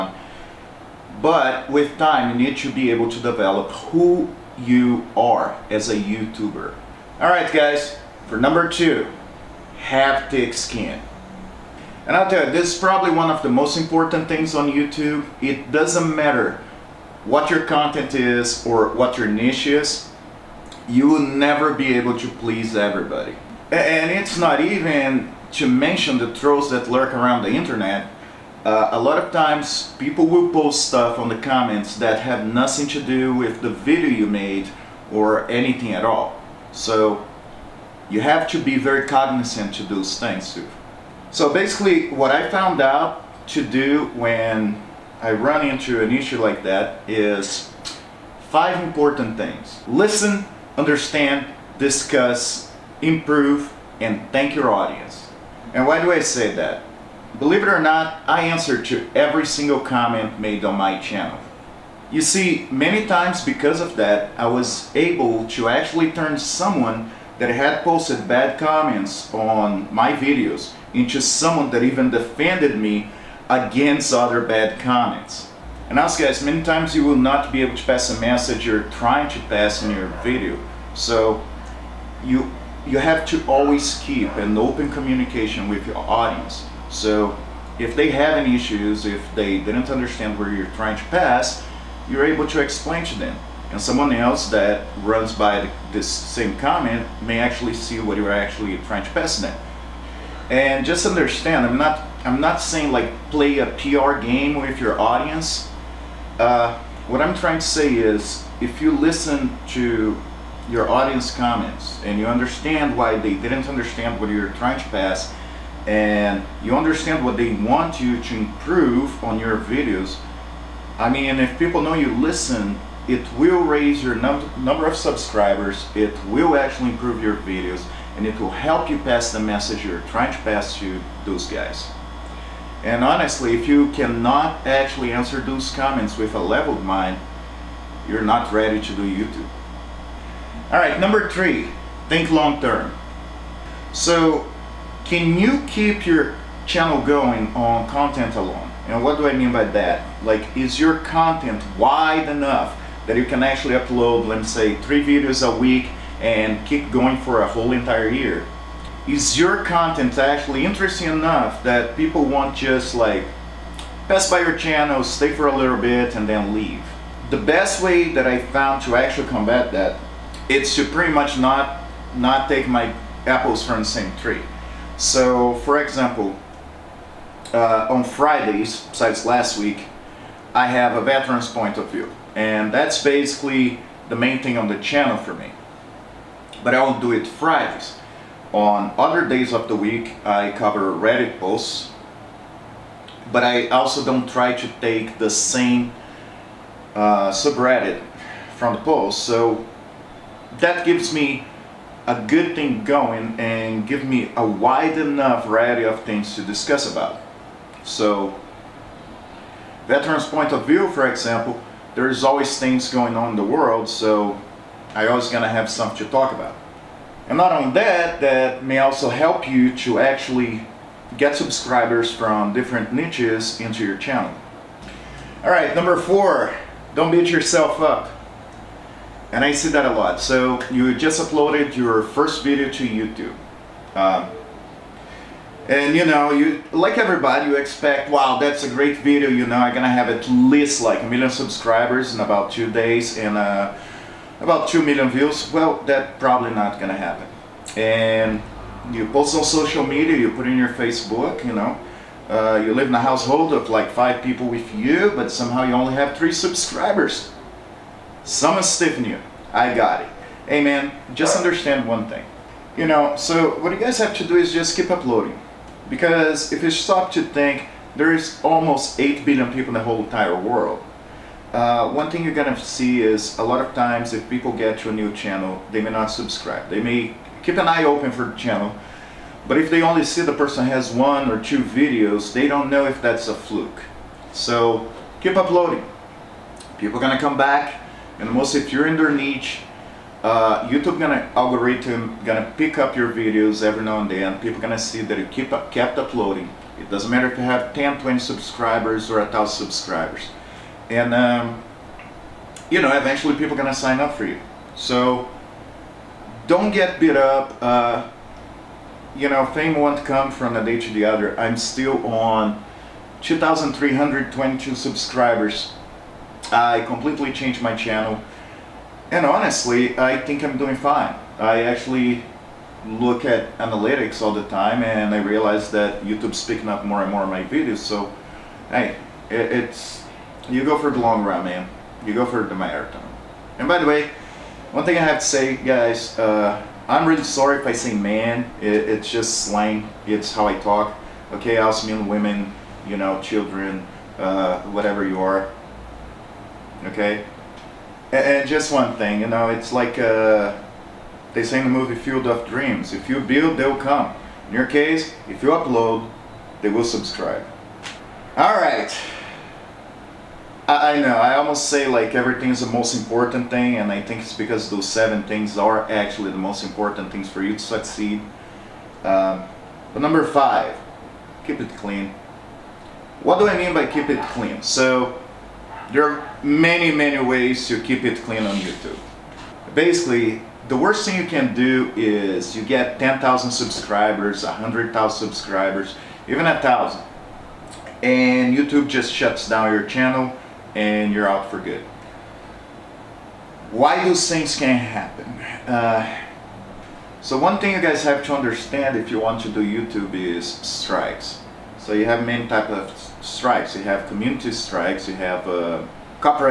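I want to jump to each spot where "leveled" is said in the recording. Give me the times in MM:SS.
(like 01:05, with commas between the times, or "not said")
02:16.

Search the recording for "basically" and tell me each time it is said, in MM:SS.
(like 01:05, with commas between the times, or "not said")
00:41, 03:03, 06:19.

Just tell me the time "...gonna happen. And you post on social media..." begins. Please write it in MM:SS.
04:06.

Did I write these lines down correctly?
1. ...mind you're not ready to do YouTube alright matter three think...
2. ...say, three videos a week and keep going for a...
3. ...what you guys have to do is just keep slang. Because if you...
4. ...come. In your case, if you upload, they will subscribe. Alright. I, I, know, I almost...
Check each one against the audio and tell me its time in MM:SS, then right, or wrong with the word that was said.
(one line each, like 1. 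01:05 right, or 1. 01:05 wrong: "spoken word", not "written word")
1. 02:16 wrong: "number", not "matter"
2. 02:34 right
3. 04:23 wrong: "uploading", not "slang"
4. 05:53 right.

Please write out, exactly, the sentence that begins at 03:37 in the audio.
And not only that, that may also help you to actually get subscribers from different niches into your channel.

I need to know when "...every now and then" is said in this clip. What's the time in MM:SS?
04:53.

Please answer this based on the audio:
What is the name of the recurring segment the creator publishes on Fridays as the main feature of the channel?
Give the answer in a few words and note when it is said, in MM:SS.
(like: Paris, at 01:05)
Veteran's Point of View, at 03:01.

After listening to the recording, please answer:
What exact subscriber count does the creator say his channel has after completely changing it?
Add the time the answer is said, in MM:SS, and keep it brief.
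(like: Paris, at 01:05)
2,322, at 05:13.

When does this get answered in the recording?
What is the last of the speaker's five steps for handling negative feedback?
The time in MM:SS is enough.
00:54.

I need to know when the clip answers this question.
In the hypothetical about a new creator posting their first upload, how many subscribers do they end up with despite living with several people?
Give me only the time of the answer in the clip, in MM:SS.
04:16.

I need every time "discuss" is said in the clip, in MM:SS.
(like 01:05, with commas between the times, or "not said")
00:51, 03:26.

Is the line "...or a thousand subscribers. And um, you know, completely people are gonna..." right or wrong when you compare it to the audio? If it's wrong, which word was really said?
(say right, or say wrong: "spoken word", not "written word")
wrong: "eventually", not "completely".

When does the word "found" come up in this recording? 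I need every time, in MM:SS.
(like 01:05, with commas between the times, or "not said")
00:42, 02:48.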